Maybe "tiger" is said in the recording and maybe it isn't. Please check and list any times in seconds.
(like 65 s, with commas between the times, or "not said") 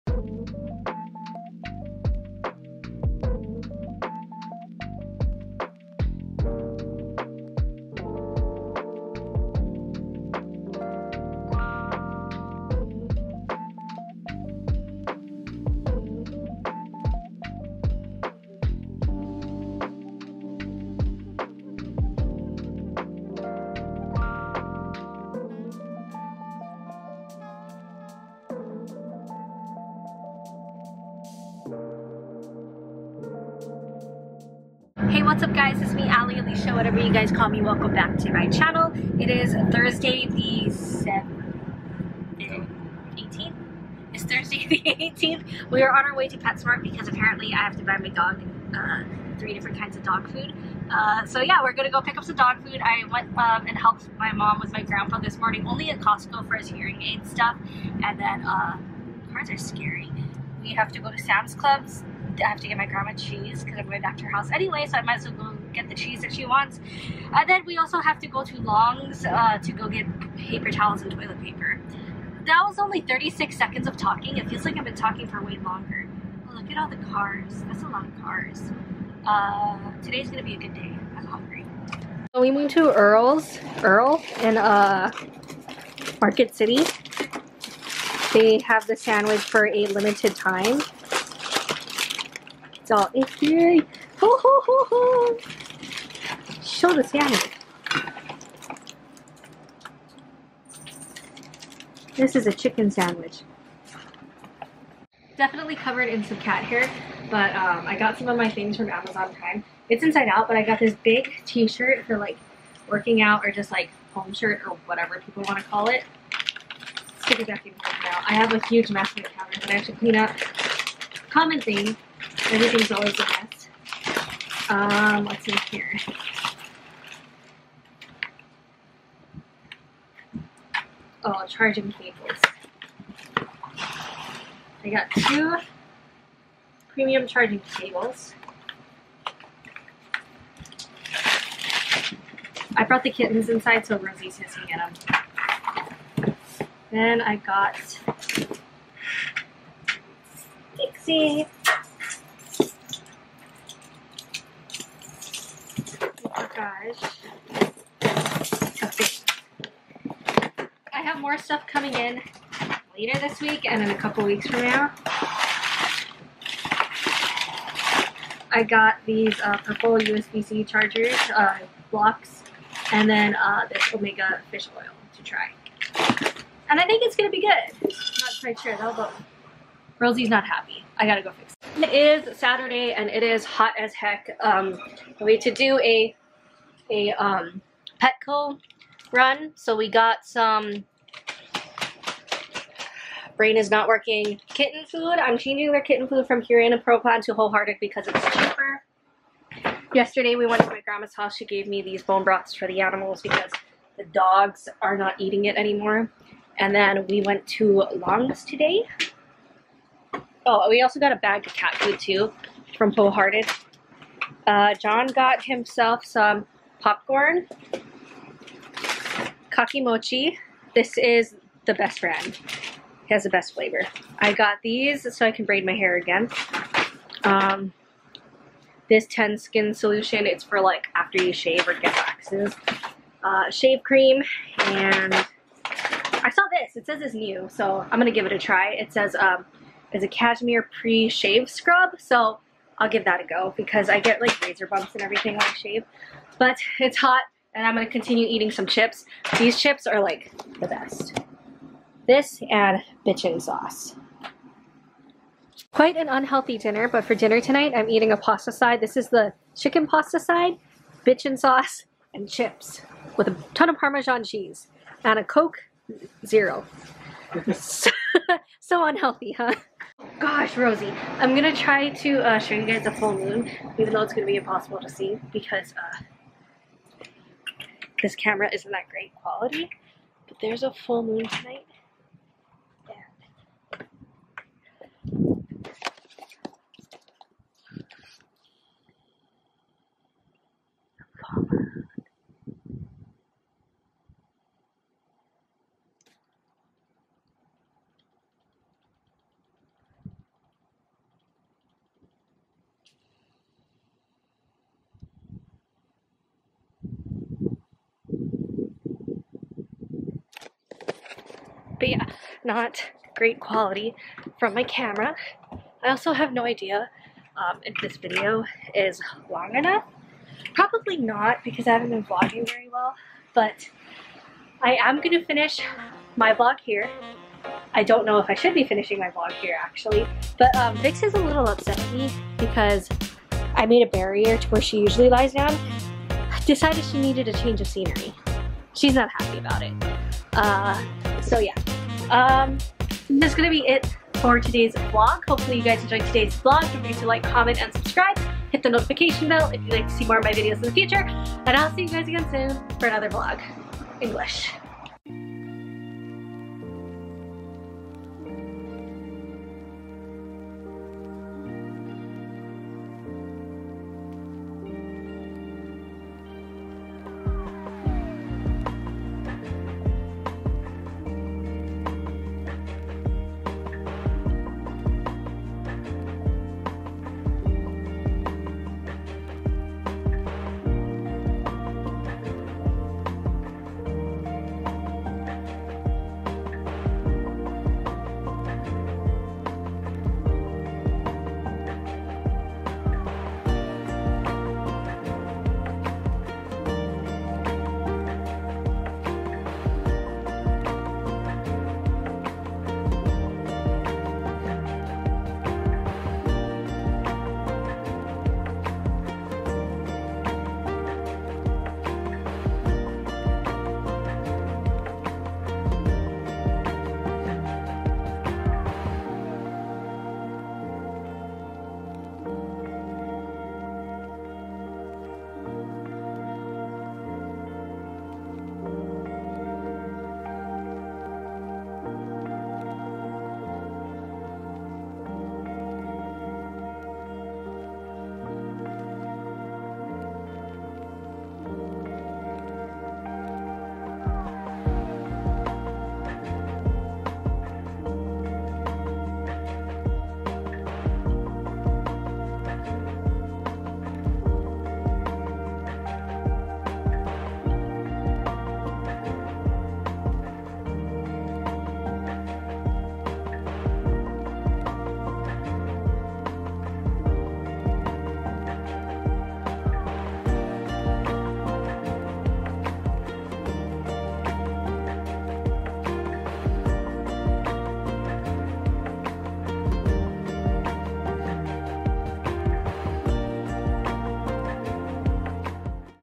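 not said.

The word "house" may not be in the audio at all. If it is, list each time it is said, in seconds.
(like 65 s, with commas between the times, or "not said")
64 s, 201 s.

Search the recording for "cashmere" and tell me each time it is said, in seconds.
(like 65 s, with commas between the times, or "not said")
240 s.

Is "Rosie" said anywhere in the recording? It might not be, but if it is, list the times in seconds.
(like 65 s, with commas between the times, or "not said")
143 s, 179 s, 270 s.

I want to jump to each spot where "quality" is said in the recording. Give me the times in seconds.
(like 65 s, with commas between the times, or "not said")
279 s, 313 s.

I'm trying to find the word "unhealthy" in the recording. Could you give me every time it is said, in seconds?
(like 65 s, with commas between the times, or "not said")
256 s, 268 s.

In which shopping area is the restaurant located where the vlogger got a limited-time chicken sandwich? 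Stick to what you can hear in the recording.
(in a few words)
Market City.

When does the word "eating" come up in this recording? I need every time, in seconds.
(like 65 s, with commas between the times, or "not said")
205 s, 248 s, 257 s.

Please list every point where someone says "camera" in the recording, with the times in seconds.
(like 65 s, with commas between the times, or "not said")
278 s, 314 s.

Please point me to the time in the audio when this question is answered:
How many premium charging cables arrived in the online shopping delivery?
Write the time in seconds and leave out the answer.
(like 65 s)
135 s.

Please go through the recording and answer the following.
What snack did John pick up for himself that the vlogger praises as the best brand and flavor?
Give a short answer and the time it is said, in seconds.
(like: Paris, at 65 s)
kakimochi, at 219 s.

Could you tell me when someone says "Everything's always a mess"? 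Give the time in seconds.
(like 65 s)
122 s.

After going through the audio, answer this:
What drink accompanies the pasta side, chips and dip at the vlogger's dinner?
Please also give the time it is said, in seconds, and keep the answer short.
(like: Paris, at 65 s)
Coke Zero, at 265 s.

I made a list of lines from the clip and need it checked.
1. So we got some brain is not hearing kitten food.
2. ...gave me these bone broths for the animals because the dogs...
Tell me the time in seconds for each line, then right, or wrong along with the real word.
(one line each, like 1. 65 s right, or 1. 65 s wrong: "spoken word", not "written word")
1. 189 s wrong: "working", not "hearing"
2. 201 s right.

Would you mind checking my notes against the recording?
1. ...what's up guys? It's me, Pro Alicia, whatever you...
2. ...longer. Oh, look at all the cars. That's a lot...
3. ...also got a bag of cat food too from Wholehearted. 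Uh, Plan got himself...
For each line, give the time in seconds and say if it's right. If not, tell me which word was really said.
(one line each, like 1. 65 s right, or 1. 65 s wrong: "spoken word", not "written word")
1. 35 s wrong: "Ali", not "Pro"
2. 75 s right
3. 210 s wrong: "John", not "Plan".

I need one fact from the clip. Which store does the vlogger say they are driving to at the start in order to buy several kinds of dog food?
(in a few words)
PetSmart.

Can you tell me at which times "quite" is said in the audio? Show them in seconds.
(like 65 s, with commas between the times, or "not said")
178 s, 255 s.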